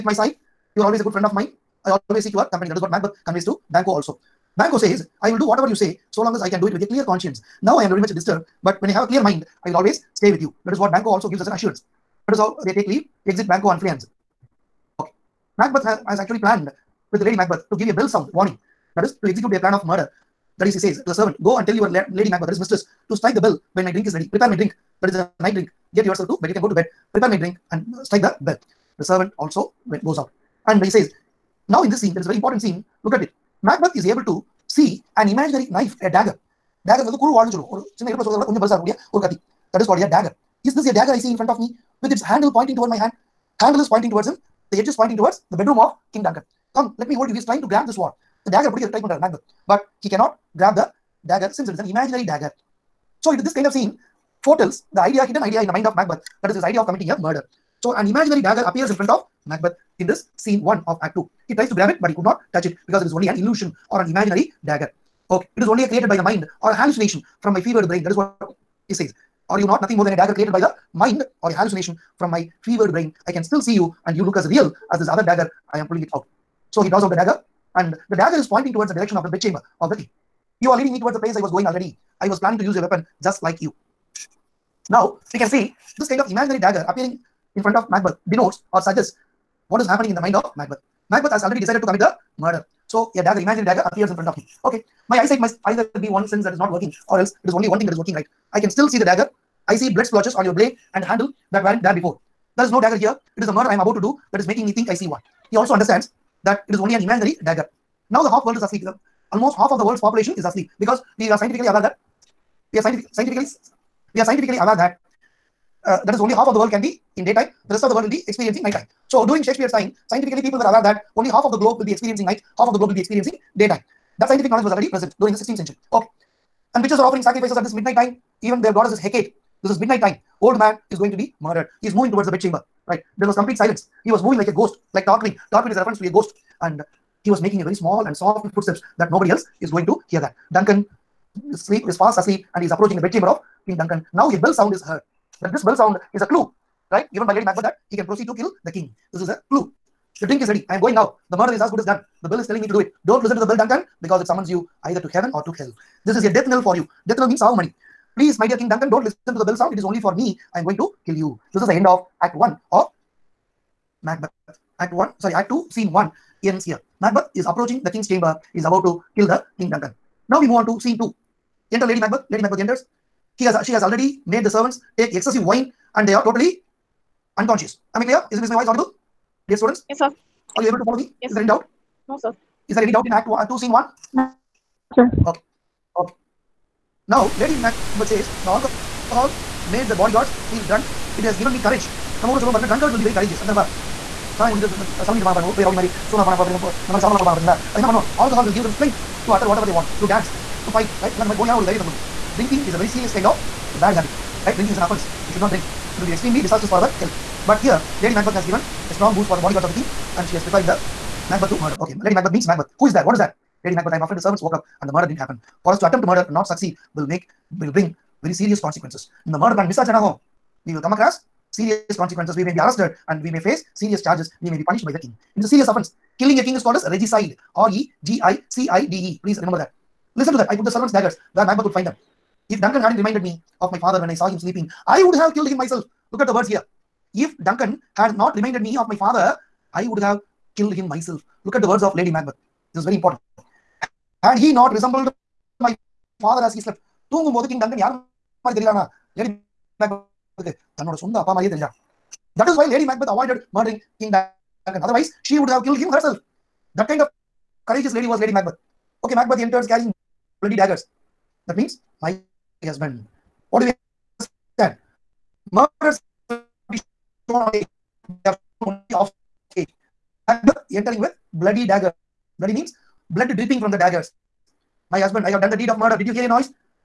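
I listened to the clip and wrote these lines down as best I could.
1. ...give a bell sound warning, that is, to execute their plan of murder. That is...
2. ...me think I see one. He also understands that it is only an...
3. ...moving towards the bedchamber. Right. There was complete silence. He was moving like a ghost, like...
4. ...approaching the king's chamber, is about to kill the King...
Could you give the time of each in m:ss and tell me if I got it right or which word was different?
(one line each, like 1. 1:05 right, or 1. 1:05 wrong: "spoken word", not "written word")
1. 0:17 right
2. 1:44 right
3. 2:11 right
4. 2:47 right.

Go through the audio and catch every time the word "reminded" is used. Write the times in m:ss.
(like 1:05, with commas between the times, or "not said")
3:53, 3:58.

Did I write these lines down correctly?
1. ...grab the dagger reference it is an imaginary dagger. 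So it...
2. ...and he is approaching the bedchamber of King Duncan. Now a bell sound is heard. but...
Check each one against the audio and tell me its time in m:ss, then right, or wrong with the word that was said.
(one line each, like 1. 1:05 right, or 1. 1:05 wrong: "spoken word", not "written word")
1. 0:50 wrong: "since", not "reference"
2. 2:22 right.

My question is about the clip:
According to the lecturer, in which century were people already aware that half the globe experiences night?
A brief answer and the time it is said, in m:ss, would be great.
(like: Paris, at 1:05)
16th century, at 2:05.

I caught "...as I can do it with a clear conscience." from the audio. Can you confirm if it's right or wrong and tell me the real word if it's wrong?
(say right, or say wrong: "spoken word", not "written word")
right.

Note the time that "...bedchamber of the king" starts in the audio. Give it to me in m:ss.
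1:19.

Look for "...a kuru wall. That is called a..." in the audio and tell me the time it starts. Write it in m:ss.
0:37.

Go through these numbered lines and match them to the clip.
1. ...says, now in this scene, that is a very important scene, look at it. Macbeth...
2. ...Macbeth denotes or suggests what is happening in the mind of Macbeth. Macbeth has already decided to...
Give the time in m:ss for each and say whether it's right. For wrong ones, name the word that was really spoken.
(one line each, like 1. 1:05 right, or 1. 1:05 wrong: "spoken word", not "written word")
1. 0:30 right
2. 1:27 right.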